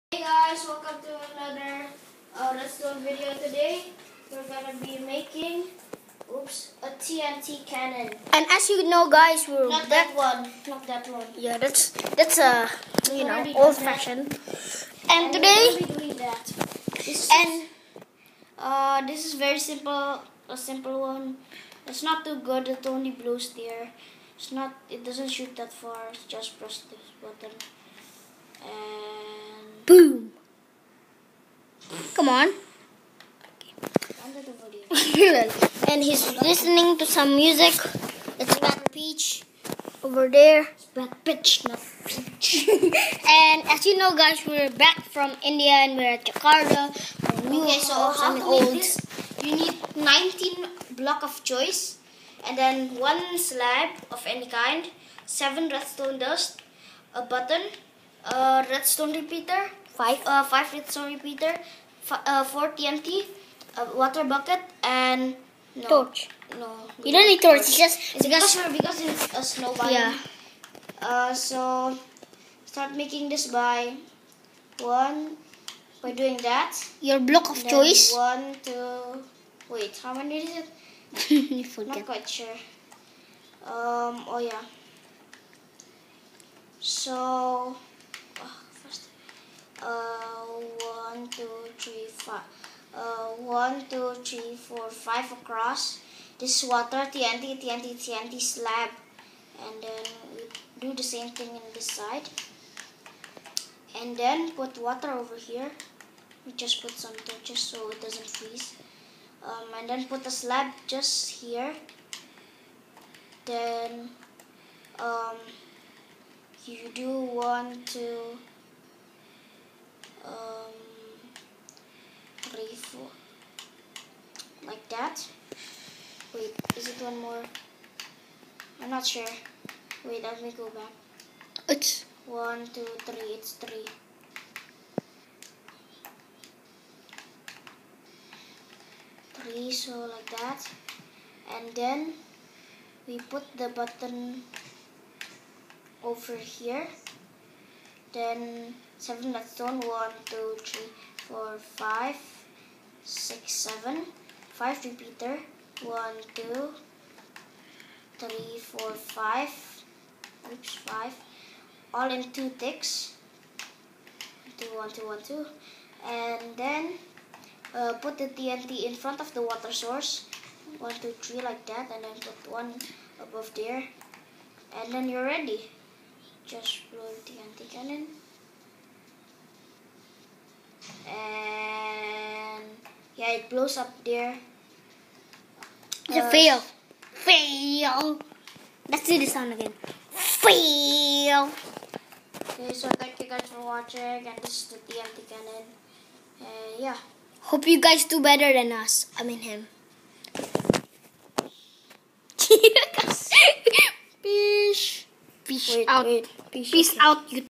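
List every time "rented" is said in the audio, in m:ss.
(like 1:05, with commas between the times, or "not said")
not said.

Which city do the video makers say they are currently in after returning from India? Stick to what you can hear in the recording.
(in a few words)
Jakarta.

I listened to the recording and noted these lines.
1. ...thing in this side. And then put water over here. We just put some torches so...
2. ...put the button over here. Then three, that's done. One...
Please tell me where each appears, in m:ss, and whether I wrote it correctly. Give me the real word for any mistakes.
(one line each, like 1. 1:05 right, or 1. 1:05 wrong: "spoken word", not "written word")
1. 1:41 right
2. 2:23 wrong: "seven", not "three".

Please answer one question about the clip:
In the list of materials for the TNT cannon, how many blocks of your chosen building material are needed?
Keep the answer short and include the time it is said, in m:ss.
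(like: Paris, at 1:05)
19, at 0:49.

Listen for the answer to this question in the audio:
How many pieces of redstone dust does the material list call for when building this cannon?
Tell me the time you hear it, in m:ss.
0:55.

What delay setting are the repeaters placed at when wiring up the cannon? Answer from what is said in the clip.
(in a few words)
2 ticks.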